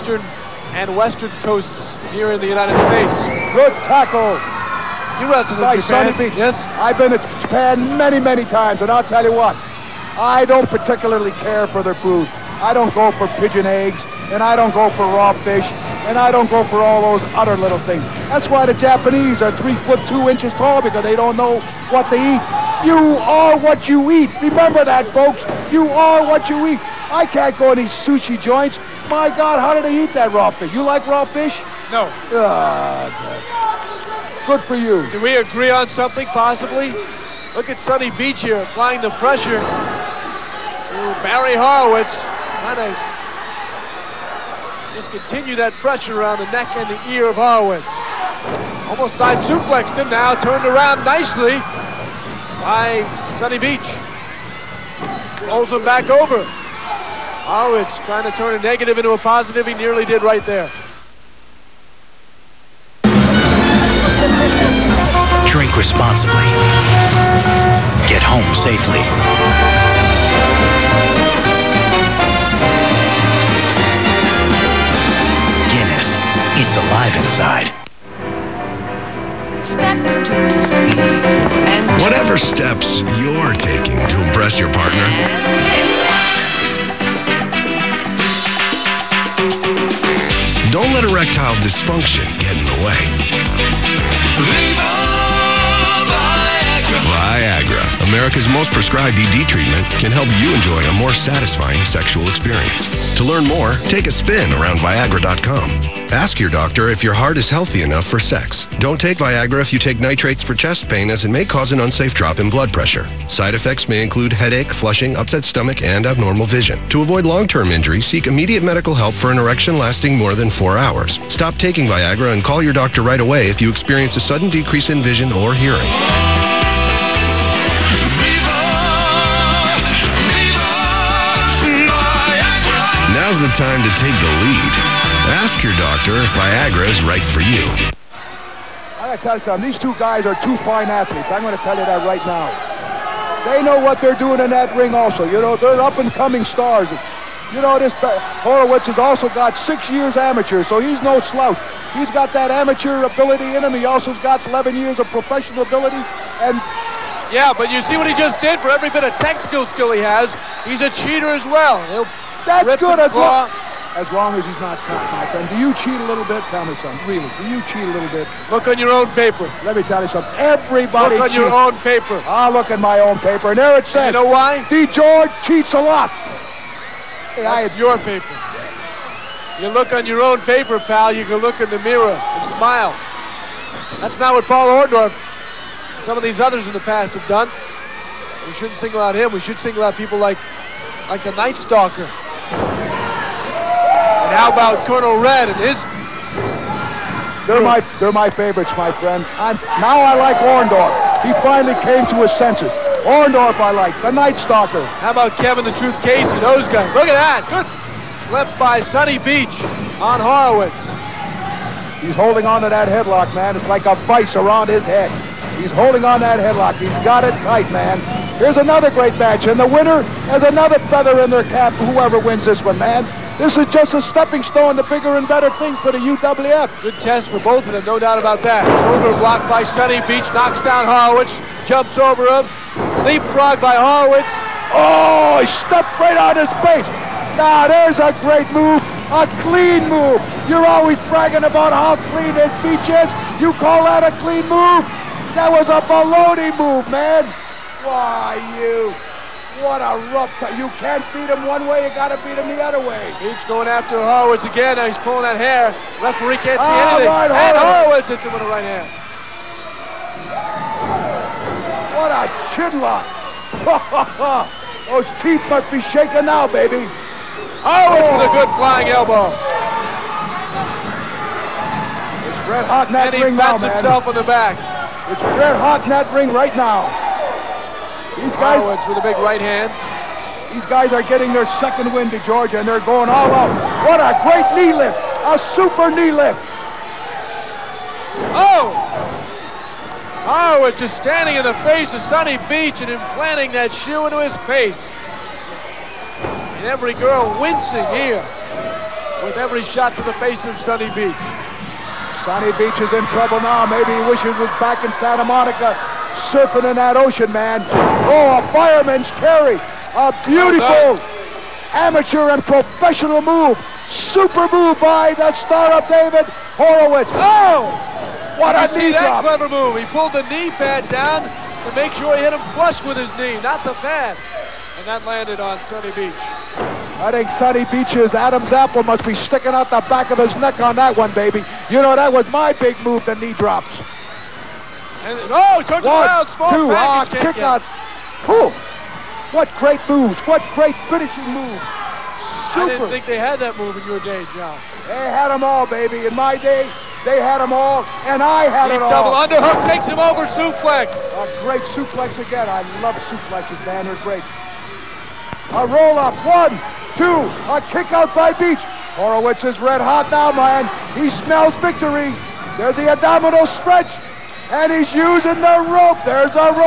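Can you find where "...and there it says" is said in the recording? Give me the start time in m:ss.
2:53.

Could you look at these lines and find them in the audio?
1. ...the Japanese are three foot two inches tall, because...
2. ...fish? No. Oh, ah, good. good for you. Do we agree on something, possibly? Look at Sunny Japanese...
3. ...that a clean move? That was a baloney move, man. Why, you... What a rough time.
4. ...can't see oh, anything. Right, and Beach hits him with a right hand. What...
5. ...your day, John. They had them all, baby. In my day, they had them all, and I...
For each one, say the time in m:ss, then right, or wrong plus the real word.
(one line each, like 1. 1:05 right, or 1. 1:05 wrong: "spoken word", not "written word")
1. 0:18 right
2. 0:31 wrong: "Beach", not "Japanese"
3. 4:03 right
4. 4:16 wrong: "Horowitz", not "Beach"
5. 5:43 right.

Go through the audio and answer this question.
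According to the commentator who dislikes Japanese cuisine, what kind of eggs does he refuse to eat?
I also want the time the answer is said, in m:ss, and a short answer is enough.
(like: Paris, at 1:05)
Pigeon eggs, at 0:13.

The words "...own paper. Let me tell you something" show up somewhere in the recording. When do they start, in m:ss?
2:48.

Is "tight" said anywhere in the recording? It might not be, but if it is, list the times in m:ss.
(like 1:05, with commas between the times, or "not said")
3:37.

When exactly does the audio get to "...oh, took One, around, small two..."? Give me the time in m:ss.
5:35.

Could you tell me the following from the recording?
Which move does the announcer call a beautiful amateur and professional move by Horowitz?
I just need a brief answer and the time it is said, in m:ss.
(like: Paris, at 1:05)
Fireman's carry, at 5:08.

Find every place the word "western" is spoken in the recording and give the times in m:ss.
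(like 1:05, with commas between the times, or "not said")
0:00.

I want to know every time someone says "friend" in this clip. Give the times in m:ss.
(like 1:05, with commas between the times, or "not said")
2:45, 3:18.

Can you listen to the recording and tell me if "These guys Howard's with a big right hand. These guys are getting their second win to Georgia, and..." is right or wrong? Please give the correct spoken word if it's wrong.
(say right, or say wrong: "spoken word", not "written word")
right.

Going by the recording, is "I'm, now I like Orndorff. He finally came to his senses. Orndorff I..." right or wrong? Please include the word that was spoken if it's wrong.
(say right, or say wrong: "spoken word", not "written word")
right.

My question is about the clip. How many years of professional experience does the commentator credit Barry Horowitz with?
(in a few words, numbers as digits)
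11.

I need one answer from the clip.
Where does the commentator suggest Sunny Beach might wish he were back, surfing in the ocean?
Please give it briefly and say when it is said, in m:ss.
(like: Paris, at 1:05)
Santa Monica, at 5:04.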